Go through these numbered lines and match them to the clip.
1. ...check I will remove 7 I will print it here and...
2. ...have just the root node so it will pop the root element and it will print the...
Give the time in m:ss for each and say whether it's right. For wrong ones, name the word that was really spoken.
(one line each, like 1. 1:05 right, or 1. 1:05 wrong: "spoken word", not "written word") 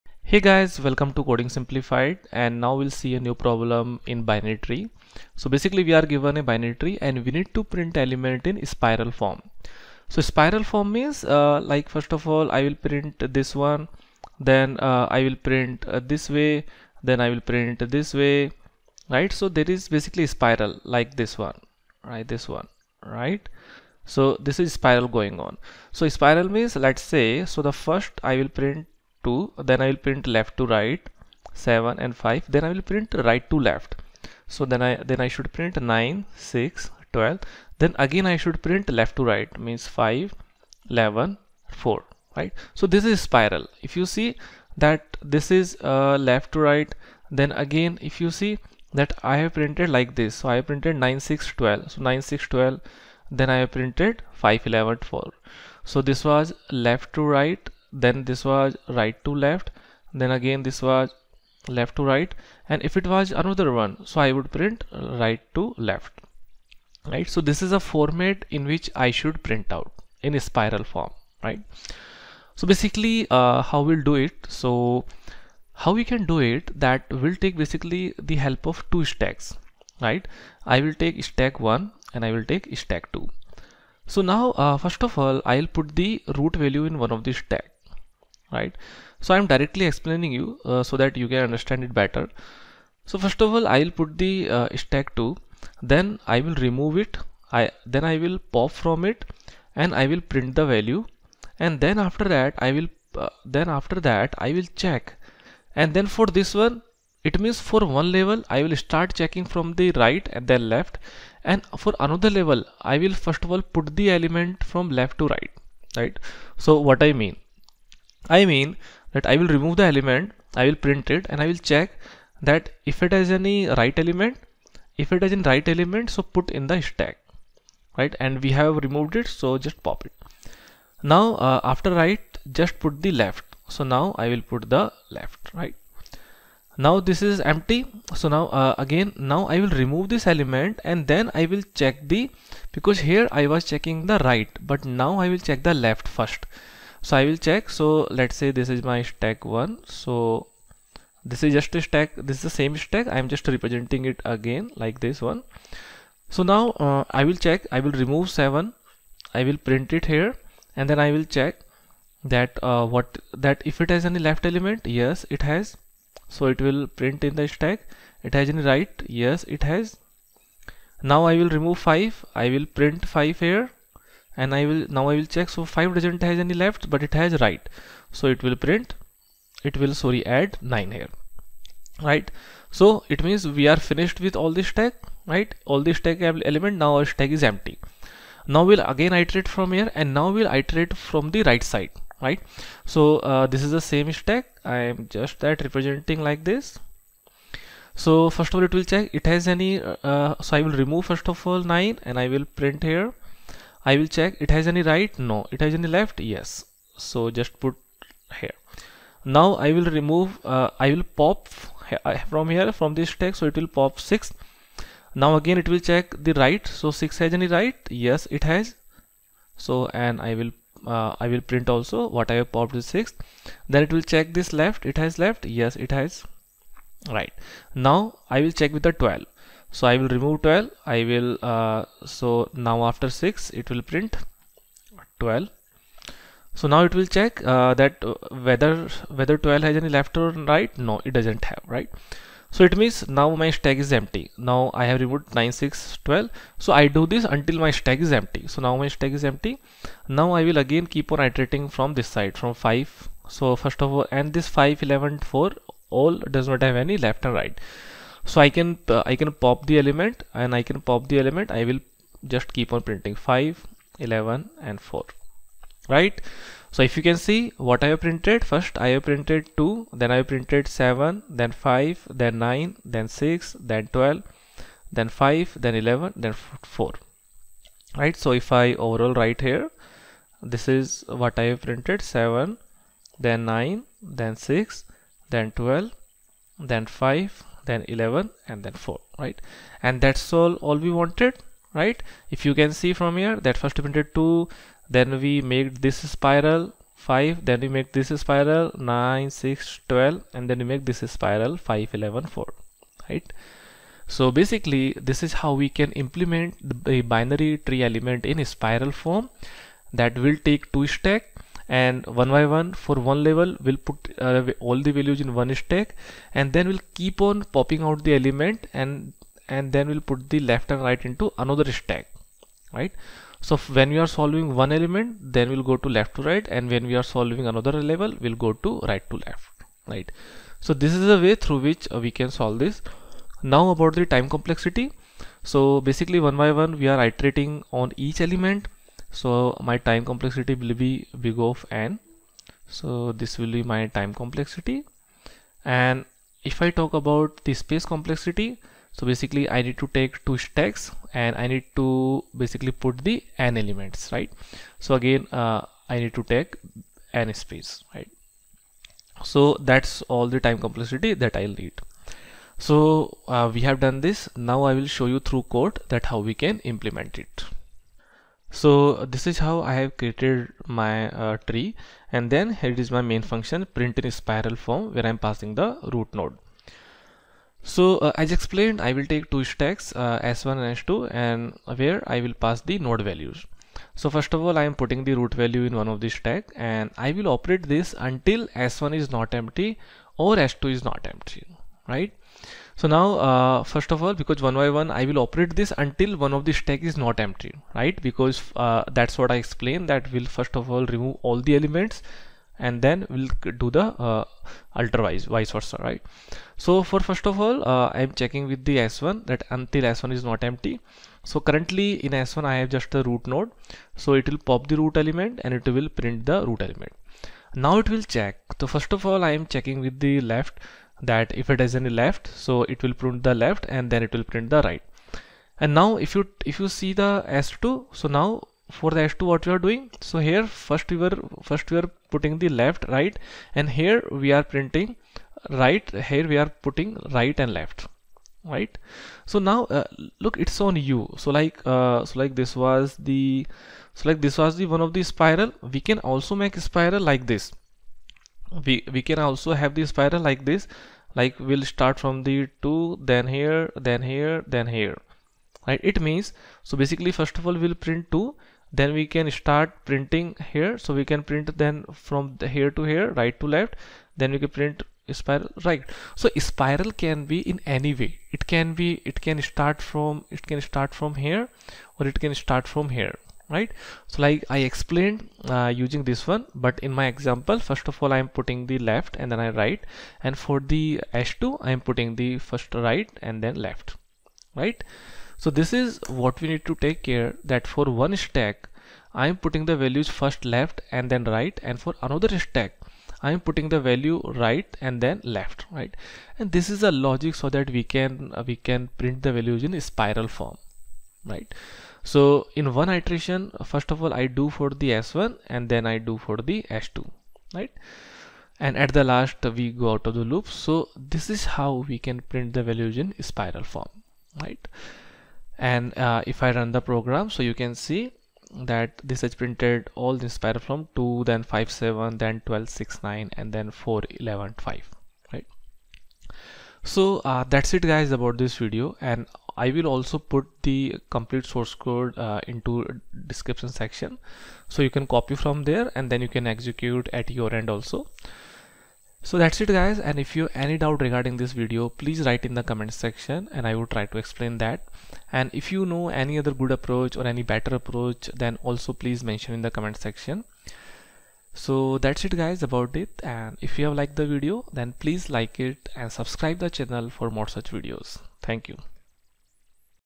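1. 2:37 right
2. 6:52 right.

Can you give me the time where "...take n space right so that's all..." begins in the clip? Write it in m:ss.
5:56.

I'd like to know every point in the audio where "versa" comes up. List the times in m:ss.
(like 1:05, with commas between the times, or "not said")
6:45.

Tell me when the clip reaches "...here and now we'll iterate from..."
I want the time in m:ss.
3:09.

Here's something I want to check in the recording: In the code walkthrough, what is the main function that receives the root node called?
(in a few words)
print in spiral form.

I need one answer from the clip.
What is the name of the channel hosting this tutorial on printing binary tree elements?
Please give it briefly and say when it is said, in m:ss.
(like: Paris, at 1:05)
Coding Simplified, at 0:01.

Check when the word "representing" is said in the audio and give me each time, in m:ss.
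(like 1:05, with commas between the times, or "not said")
2:33, 3:15.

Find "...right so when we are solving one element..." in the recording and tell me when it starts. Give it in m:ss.
5:22.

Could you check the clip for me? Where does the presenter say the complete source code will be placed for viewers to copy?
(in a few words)
description section.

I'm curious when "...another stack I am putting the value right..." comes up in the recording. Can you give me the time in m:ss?
8:12.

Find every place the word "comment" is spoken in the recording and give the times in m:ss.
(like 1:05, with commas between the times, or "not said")
9:02, 9:09.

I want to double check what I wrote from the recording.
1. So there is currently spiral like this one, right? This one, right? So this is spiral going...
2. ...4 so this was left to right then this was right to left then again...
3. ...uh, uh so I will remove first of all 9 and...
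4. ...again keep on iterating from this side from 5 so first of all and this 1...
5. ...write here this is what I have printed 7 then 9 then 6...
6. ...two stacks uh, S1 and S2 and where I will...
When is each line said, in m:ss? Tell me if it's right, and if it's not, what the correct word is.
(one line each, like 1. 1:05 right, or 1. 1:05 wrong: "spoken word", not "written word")
1. 0:19 wrong: "basically", not "currently"
2. 0:55 right
3. 3:19 right
4. 4:10 wrong: "5", not "1"
5. 4:39 right
6. 6:19 right.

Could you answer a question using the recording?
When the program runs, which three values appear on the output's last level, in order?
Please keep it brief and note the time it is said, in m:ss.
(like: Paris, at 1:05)
4 11 5, at 8:43.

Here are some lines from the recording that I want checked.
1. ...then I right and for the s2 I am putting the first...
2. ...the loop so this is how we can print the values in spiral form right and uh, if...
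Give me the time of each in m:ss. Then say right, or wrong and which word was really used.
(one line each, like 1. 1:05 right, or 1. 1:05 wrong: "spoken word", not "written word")
1. 7:59 right
2. 8:30 right.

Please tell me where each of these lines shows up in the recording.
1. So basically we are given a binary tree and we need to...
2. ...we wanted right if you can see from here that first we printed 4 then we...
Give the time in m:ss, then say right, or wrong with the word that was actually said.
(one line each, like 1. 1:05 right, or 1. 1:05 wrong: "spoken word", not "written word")
1. 0:05 right
2. 4:50 wrong: "2", not "4".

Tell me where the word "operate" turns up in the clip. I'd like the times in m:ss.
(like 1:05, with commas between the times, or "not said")
6:27, 6:35.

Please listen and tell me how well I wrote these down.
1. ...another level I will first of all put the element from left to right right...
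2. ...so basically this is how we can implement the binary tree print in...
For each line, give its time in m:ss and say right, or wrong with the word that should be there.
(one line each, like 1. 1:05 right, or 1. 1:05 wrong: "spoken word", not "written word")
1. 1:51 right
2. 5:04 wrong: "element", not "print".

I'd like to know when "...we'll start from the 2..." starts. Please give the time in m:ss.
7:31.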